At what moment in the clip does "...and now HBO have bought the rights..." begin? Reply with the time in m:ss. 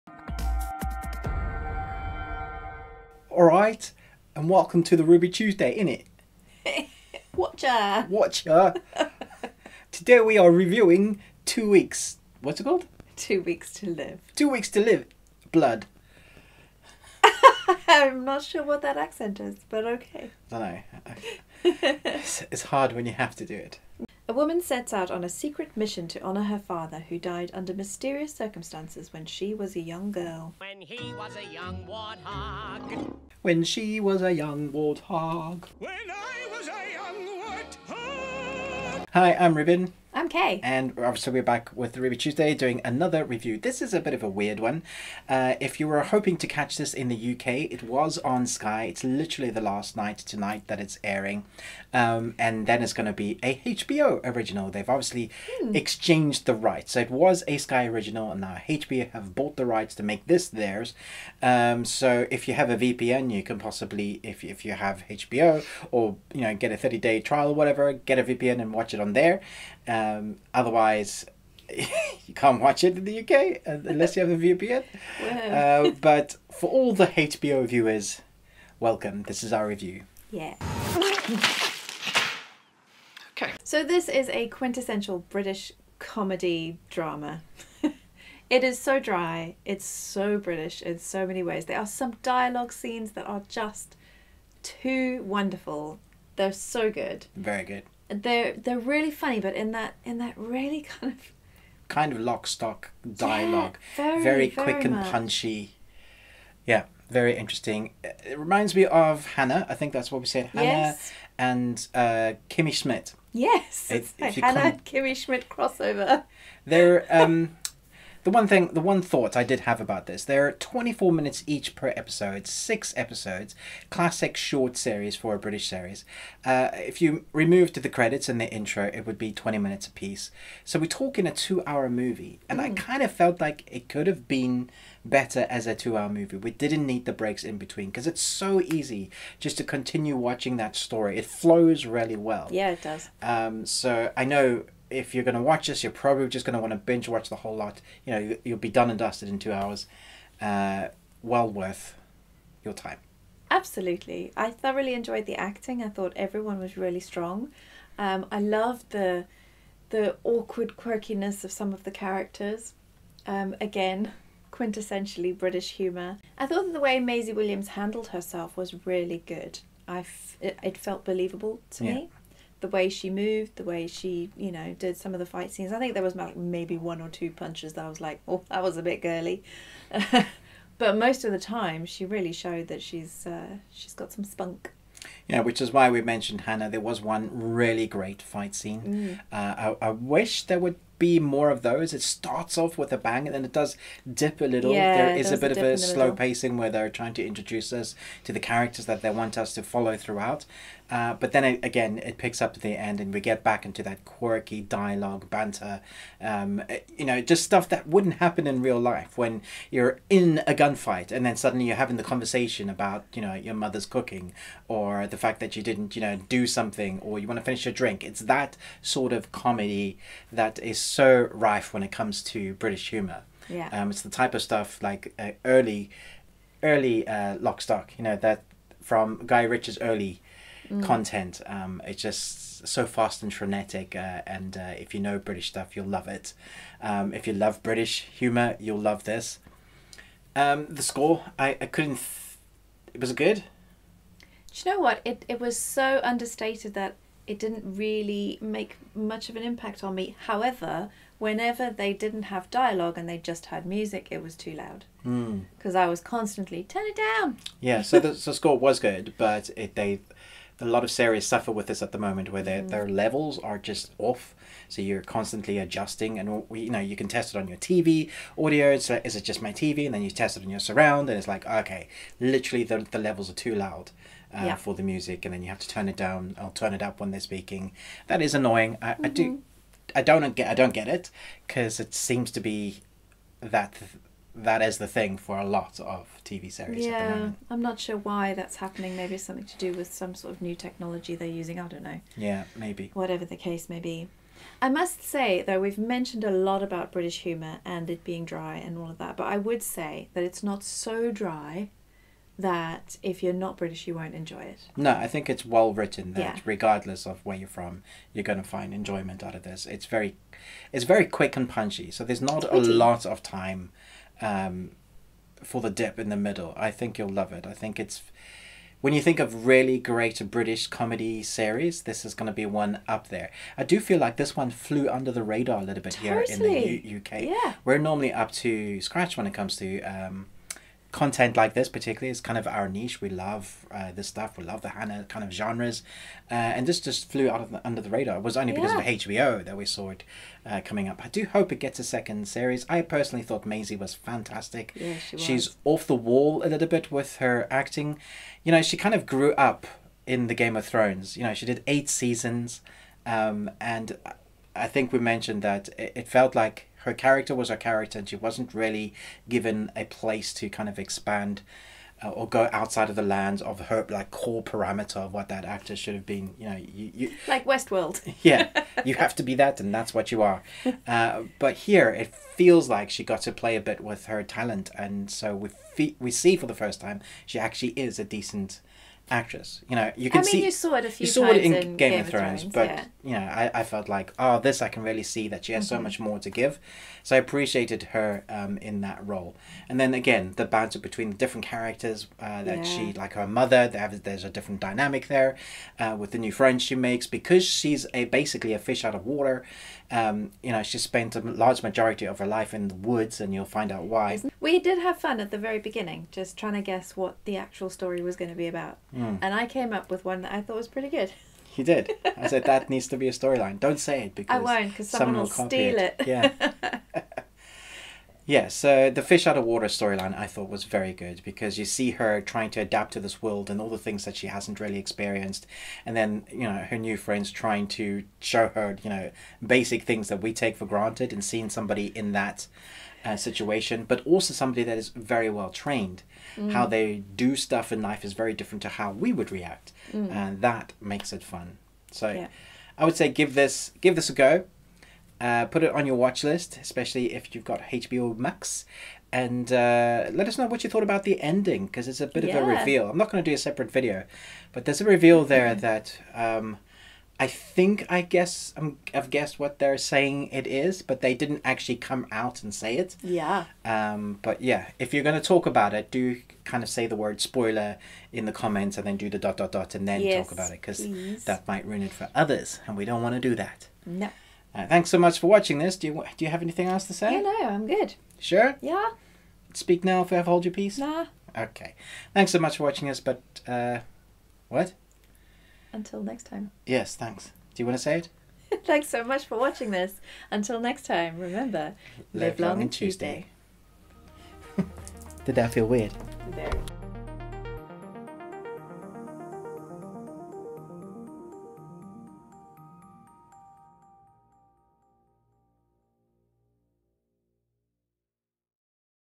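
0:58.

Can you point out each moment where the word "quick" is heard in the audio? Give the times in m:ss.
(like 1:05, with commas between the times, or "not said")
1:44, 5:11.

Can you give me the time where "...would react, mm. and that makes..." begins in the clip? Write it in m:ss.
7:19.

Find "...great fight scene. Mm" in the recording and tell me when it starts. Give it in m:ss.
3:07.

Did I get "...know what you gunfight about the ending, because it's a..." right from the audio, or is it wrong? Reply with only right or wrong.
wrong.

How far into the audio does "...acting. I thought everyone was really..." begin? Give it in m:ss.
2:35.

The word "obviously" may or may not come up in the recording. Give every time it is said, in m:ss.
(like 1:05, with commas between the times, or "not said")
0:40, 0:54.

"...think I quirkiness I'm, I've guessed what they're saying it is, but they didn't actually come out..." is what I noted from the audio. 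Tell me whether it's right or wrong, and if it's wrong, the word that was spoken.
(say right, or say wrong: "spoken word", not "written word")
wrong: "guess", not "quirkiness".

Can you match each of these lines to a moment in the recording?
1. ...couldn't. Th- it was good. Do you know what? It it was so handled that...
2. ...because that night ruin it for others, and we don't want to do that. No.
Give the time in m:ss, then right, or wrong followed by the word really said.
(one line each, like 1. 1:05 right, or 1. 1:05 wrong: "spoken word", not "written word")
1. 4:01 wrong: "understated", not "handled"
2. 7:50 wrong: "might", not "night".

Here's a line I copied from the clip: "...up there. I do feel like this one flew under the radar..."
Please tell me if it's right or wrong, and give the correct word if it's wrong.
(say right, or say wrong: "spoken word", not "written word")
right.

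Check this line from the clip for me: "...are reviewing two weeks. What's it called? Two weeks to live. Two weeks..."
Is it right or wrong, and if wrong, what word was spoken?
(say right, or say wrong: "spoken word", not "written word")
right.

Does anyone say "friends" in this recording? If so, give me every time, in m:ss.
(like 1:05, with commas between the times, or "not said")
6:36, 7:06.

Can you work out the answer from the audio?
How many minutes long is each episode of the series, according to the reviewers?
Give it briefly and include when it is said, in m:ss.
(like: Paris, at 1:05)
24, at 2:00.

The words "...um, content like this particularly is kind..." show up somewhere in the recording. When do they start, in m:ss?
5:29.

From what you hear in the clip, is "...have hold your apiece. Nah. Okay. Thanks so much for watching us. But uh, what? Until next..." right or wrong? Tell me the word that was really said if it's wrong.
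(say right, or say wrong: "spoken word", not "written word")
wrong: "peace", not "apiece".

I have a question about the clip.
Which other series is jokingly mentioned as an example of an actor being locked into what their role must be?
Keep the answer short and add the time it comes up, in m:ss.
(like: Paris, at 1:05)
Westworld, at 6:07.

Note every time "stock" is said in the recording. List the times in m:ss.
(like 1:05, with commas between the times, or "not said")
1:42, 3:47.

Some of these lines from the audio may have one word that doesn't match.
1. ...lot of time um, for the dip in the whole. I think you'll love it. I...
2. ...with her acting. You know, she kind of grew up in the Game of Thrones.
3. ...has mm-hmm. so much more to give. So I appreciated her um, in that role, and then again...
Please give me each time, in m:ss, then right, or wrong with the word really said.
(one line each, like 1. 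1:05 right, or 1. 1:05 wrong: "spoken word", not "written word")
1. 5:12 wrong: "middle", not "whole"
2. 5:46 right
3. 6:25 right.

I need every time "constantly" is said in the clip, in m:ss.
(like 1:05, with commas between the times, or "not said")
4:16, 4:25.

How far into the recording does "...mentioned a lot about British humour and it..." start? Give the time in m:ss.
4:55.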